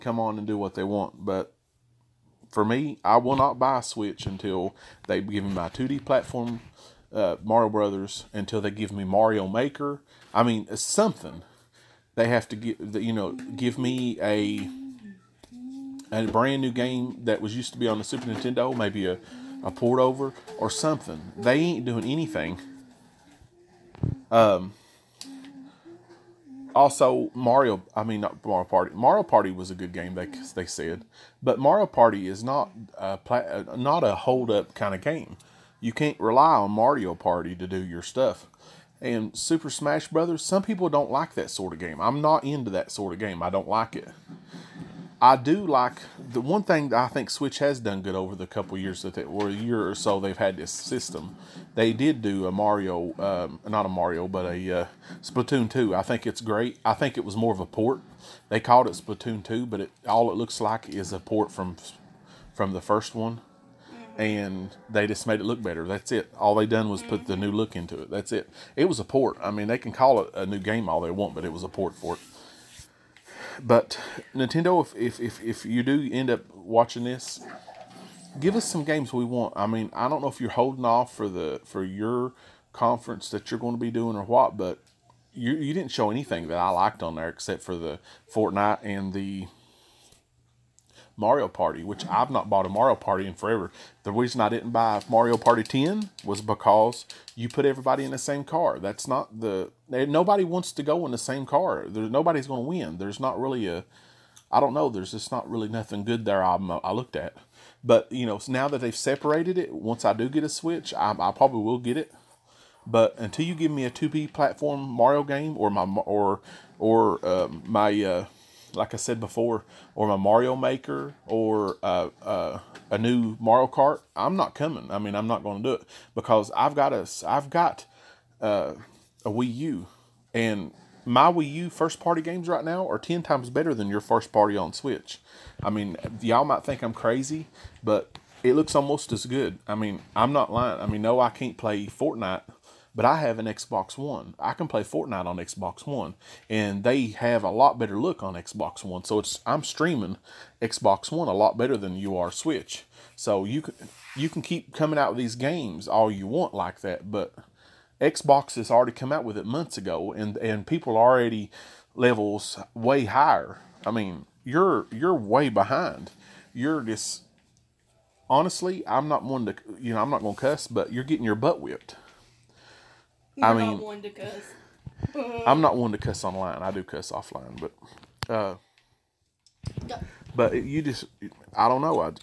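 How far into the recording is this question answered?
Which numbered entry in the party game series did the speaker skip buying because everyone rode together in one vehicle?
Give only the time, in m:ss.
1:35.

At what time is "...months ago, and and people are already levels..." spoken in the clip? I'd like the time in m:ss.
2:39.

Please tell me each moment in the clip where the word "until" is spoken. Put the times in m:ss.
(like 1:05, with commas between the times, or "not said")
0:04, 0:08, 1:53.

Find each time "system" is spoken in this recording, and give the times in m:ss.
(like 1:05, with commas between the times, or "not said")
0:50.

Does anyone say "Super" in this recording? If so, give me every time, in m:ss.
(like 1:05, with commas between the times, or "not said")
0:18, 0:39.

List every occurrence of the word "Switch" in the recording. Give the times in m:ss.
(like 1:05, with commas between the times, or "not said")
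0:03, 0:47, 1:50, 2:14, 2:32.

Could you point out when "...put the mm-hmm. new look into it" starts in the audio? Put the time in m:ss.
1:07.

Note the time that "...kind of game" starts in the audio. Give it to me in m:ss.
0:34.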